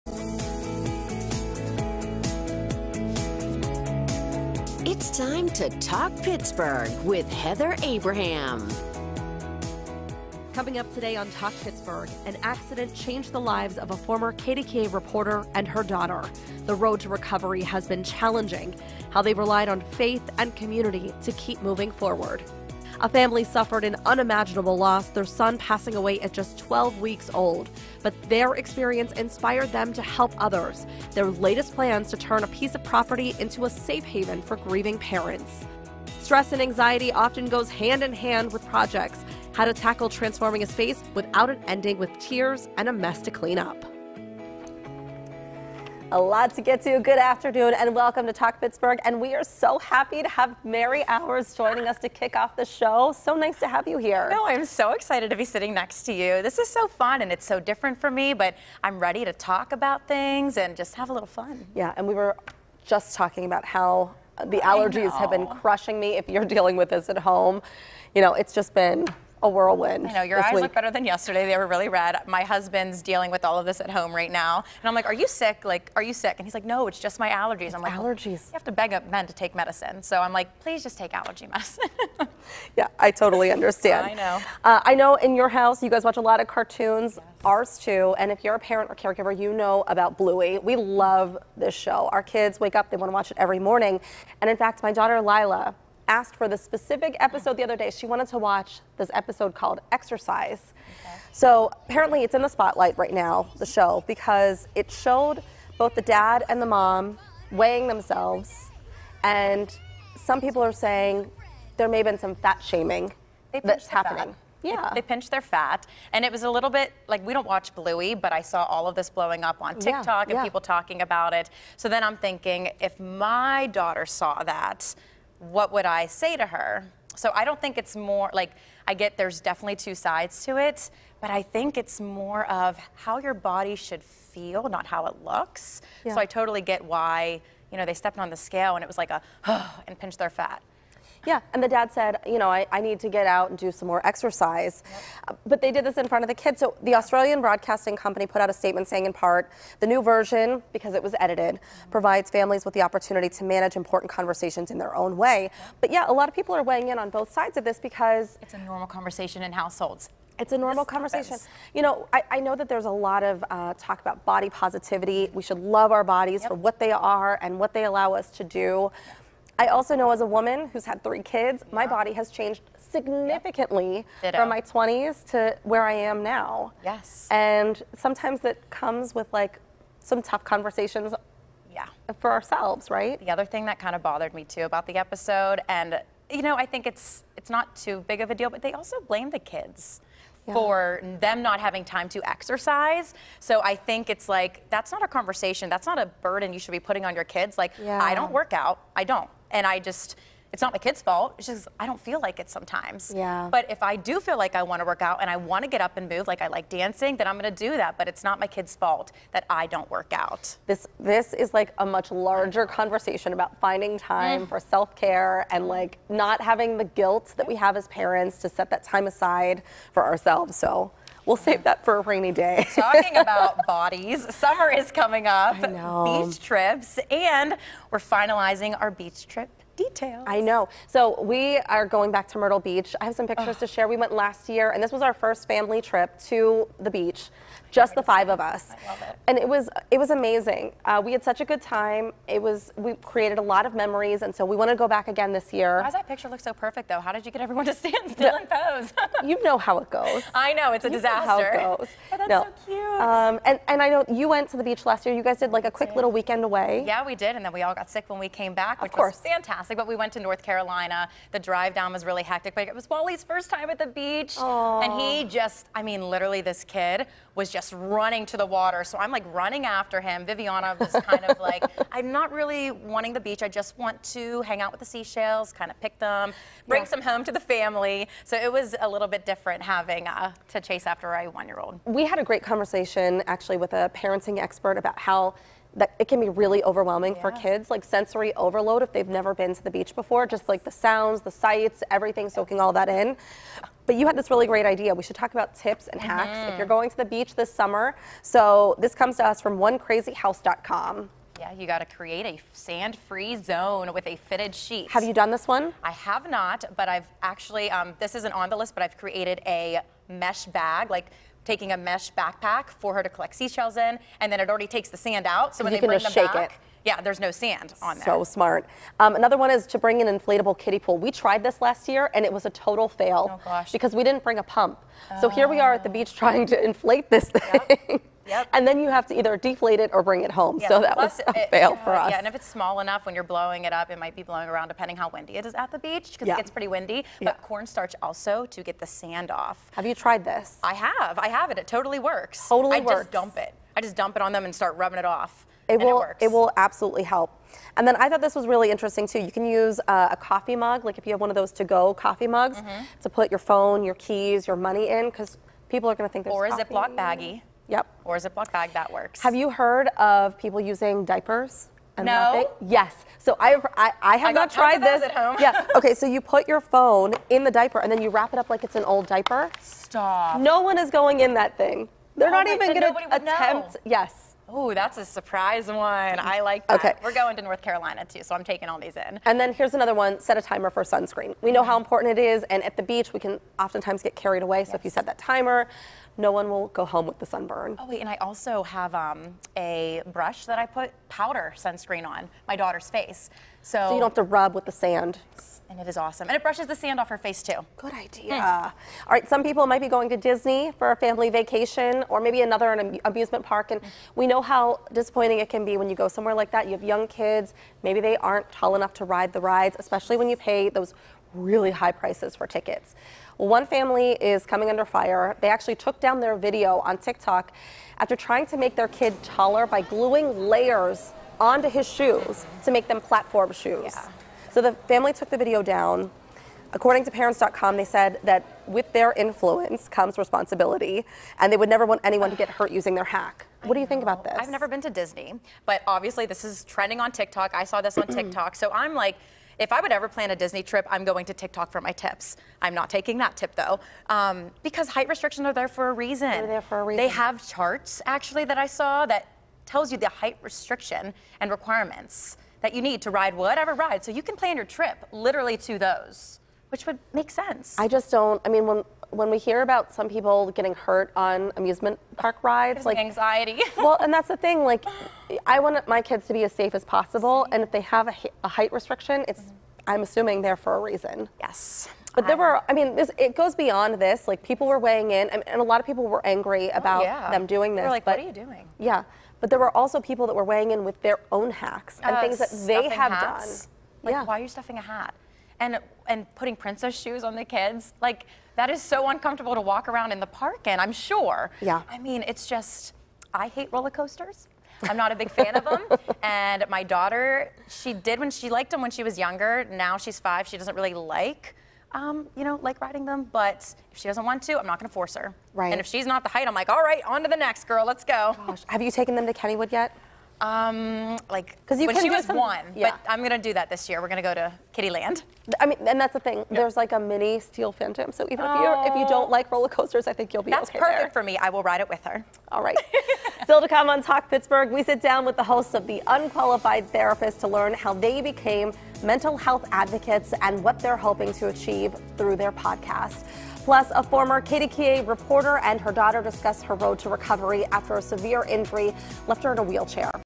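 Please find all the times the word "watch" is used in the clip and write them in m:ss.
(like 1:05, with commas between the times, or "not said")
1:26, 1:33, 1:38, 1:57.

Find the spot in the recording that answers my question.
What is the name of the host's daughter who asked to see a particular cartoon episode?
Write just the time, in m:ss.
1:35.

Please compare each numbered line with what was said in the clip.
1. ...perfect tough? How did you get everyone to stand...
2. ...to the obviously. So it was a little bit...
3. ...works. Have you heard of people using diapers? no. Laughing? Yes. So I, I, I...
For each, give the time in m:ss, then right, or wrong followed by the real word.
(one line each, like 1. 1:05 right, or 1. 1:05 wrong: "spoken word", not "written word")
1. 4:06 wrong: "though", not "tough"
2. 4:37 wrong: "family", not "obviously"
3. 5:58 right.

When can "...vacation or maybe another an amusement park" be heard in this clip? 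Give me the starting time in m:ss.
6:41.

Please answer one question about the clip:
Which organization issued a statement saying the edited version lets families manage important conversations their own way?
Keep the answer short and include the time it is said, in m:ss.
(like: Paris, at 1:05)
Australian Broadcasting Company, at 2:26.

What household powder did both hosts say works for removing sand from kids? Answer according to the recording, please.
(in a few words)
Cornstarch.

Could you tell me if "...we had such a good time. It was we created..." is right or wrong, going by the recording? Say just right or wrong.
right.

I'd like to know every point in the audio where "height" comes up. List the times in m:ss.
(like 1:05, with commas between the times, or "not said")
7:24, 7:30, 7:48, 8:26.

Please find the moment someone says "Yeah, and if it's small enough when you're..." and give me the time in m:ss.
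5:32.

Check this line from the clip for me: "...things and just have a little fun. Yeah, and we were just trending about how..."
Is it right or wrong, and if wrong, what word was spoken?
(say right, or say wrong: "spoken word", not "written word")
wrong: "talking", not "trending".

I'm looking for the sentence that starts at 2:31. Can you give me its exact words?
provides families with the opportunity to manage important conversations in their own way.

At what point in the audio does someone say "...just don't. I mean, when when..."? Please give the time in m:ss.
7:37.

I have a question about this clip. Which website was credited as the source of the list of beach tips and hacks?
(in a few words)
onecrazyhouse.com.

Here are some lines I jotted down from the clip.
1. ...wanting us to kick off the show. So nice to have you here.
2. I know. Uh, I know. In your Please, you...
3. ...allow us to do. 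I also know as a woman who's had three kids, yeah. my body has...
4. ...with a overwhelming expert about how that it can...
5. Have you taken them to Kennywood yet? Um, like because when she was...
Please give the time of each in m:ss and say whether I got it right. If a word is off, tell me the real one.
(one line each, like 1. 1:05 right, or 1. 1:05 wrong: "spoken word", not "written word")
1. 0:51 wrong: "joining", not "wanting"
2. 1:24 wrong: "house", not "Please"
3. 2:47 right
4. 4:43 wrong: "parenting", not "overwhelming"
5. 8:28 right.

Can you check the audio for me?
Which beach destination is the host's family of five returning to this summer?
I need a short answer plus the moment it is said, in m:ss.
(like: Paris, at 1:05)
Myrtle Beach, at 3:52.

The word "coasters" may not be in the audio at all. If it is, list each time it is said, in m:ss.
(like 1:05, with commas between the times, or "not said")
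8:13, 8:39.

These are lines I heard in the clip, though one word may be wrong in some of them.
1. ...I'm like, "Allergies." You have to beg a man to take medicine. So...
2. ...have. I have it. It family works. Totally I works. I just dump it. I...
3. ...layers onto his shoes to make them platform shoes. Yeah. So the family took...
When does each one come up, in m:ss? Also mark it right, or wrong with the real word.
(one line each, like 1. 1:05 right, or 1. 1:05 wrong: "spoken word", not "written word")
1. 1:17 right
2. 5:40 wrong: "totally", not "family"
3. 7:00 right.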